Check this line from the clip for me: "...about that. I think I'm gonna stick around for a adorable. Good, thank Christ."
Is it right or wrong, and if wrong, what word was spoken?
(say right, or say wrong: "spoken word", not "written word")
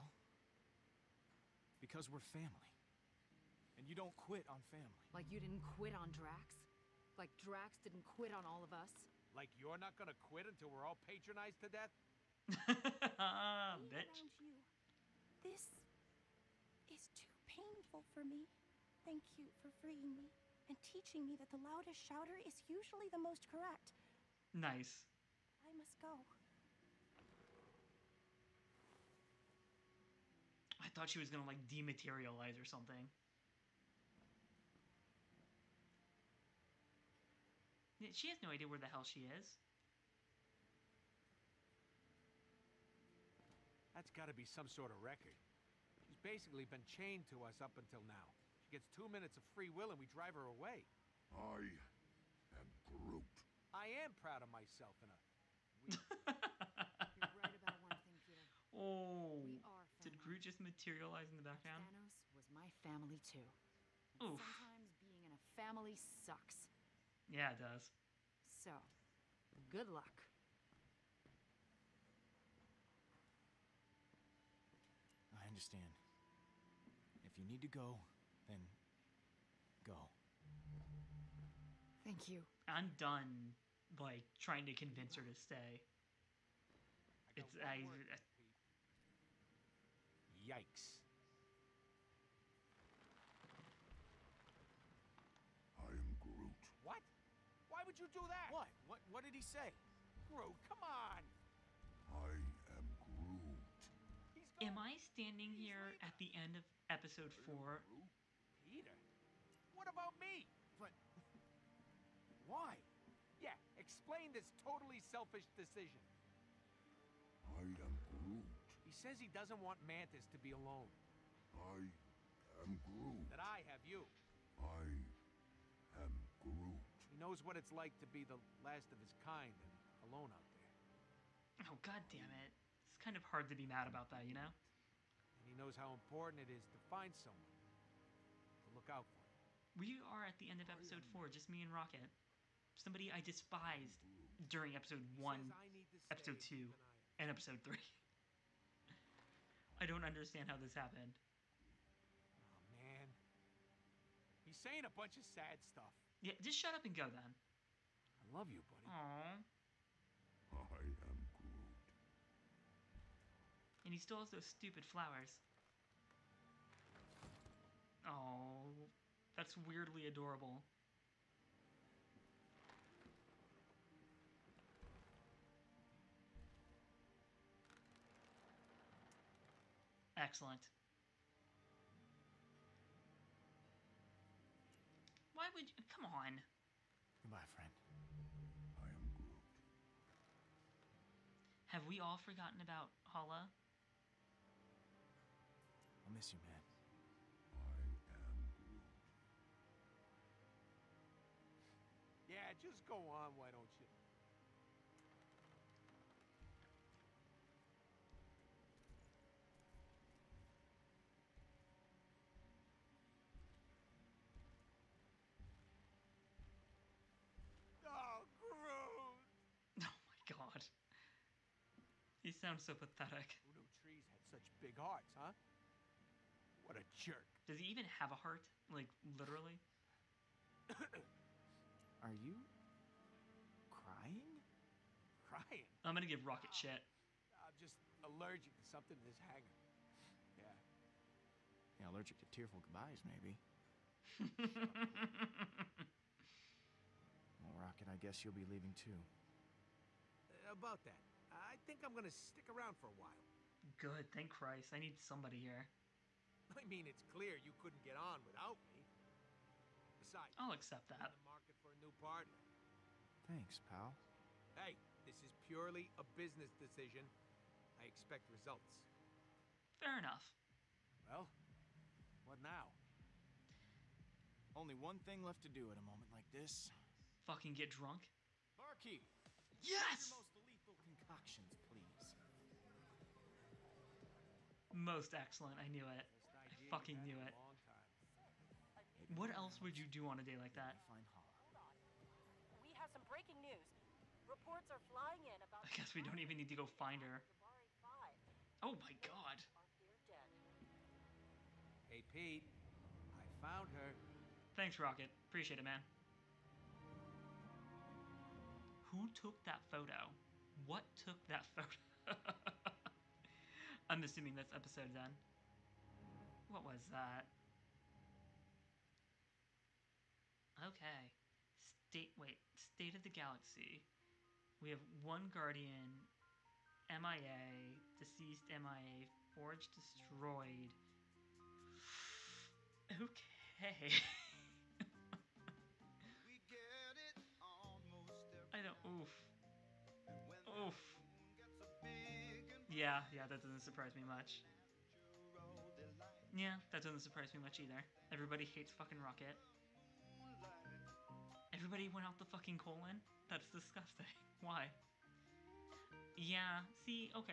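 wrong: "while", not "adorable".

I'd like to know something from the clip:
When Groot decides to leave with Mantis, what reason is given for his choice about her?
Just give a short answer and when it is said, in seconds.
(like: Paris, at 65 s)
He doesn't want Mantis to be alone, at 119 s.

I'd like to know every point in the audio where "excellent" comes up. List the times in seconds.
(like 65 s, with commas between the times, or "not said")
180 s, 285 s.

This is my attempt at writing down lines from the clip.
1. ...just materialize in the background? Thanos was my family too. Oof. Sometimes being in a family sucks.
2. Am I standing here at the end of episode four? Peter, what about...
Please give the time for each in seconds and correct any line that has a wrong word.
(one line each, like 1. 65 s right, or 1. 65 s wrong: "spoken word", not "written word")
1. 60 s right
2. 104 s right.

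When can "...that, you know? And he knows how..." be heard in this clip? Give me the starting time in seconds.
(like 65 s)
134 s.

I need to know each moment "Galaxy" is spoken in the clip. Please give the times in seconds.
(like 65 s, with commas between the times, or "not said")
323 s.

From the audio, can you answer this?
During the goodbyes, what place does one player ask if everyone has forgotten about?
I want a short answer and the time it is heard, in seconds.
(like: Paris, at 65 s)
Hala, at 193 s.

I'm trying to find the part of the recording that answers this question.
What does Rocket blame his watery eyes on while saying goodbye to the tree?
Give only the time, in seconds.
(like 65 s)
238 s.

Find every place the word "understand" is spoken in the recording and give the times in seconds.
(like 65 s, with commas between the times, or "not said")
75 s, 150 s.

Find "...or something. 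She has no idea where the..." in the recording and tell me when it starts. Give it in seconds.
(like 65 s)
32 s.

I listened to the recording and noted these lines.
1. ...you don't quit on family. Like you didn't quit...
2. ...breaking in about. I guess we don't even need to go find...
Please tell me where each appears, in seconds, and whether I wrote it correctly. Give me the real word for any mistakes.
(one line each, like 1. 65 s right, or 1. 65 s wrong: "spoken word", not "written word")
1. 3 s right
2. 294 s wrong: "flying", not "breaking".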